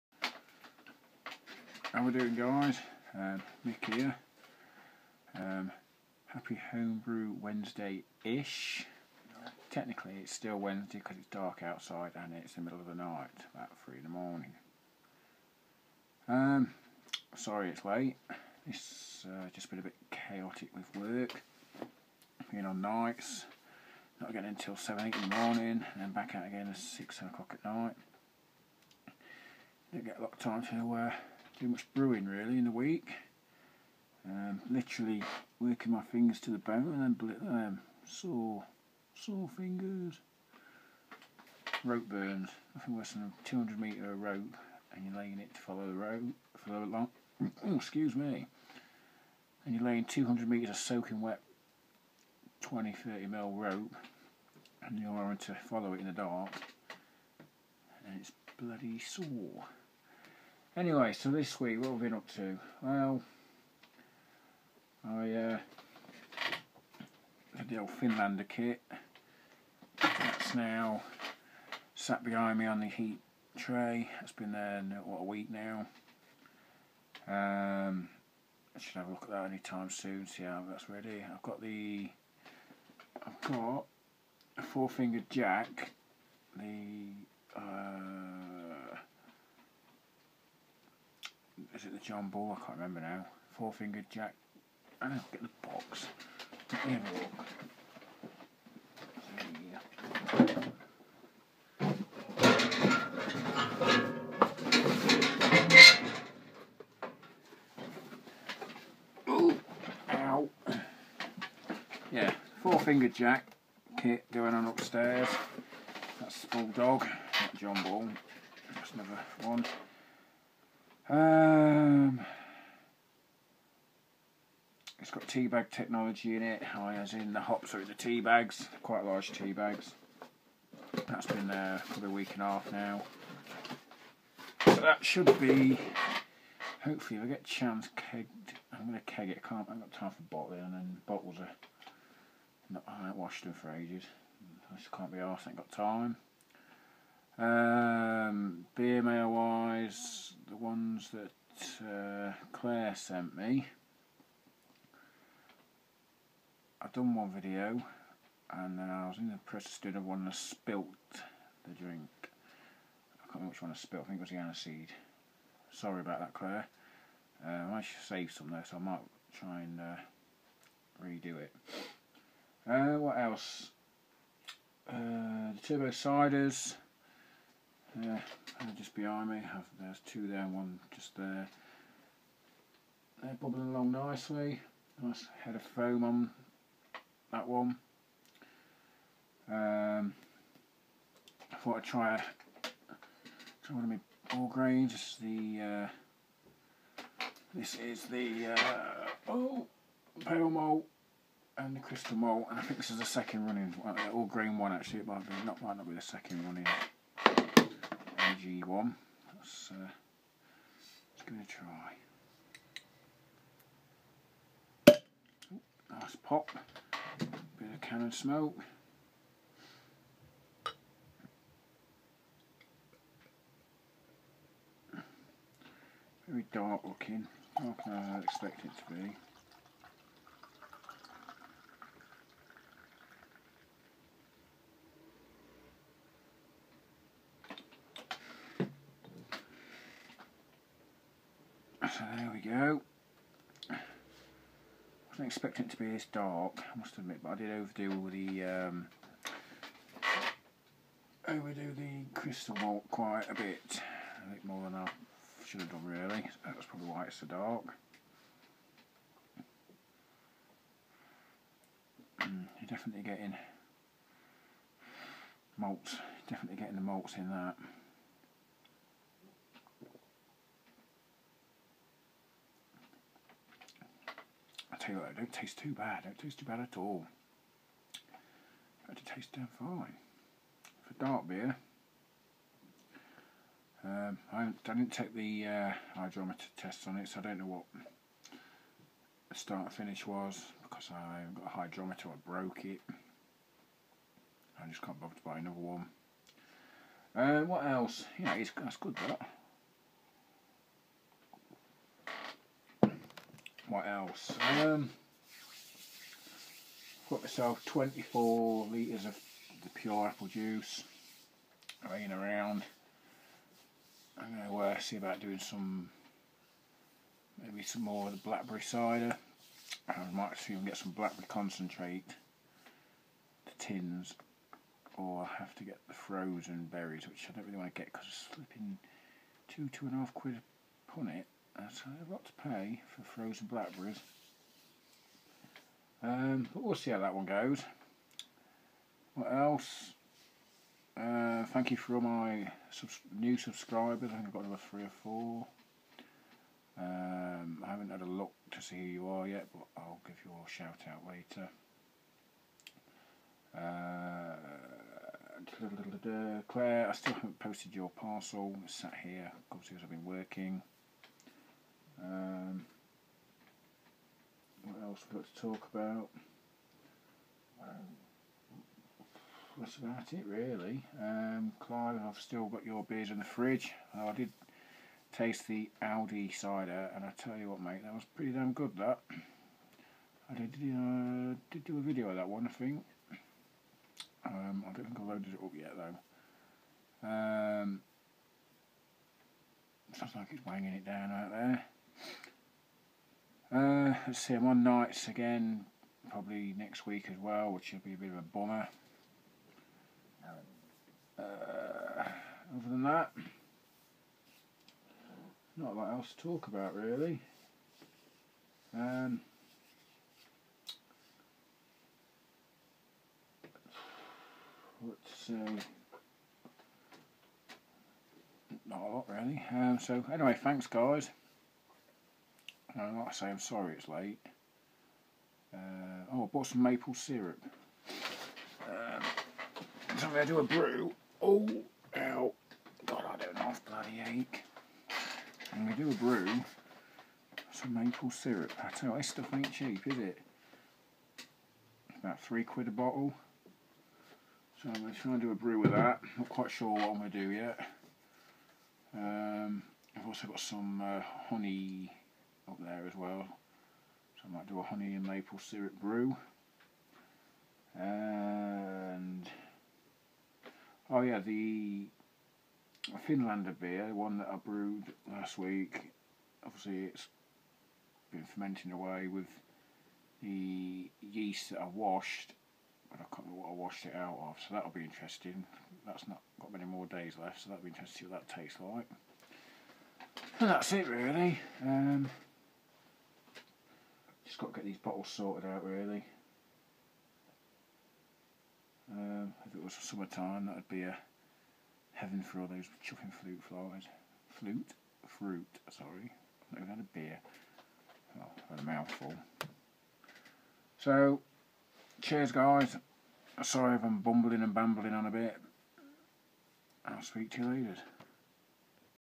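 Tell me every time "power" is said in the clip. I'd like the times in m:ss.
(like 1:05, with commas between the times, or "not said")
not said.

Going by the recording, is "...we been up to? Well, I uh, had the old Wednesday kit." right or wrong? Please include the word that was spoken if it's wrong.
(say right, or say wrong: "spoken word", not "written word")
wrong: "Finlander", not "Wednesday".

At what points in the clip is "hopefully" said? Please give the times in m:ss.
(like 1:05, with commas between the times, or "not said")
2:16.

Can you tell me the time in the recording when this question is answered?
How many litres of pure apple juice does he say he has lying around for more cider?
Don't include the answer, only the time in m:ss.
5:07.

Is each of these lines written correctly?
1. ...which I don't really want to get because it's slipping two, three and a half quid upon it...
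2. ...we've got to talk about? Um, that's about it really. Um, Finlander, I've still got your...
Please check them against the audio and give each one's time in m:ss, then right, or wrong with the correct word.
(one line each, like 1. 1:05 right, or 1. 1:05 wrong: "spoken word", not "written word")
1. 5:27 wrong: "two", not "three"
2. 6:05 wrong: "Clive", not "Finlander".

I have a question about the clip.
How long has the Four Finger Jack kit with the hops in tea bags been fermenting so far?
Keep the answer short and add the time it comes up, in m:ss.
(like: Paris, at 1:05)
a week and a half, at 2:12.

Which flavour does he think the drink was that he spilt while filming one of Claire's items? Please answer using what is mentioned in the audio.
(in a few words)
aniseed.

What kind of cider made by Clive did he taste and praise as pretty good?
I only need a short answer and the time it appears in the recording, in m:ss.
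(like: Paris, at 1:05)
Audi cider, at 6:15.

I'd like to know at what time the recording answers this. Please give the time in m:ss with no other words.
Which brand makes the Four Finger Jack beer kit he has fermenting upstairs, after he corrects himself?
1:56.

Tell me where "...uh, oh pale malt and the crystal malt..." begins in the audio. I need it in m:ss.
3:18.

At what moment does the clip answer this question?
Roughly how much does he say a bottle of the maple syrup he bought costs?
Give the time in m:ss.
7:22.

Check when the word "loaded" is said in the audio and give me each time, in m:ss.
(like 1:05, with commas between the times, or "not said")
6:25.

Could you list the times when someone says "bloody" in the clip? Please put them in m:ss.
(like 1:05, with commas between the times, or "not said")
0:58, 7:13.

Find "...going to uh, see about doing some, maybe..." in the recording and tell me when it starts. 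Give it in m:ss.
5:14.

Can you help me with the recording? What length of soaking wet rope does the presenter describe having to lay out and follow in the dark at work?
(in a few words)
200 metres.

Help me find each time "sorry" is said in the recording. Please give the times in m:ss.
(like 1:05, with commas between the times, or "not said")
0:17, 2:45, 7:03, 8:15, 8:23.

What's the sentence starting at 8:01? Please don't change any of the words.
Um, just got to get these bottles sorted out really.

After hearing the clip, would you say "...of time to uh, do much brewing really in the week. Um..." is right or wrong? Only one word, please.
right.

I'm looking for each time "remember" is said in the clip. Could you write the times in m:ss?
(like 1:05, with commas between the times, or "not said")
1:32, 2:43, 7:53.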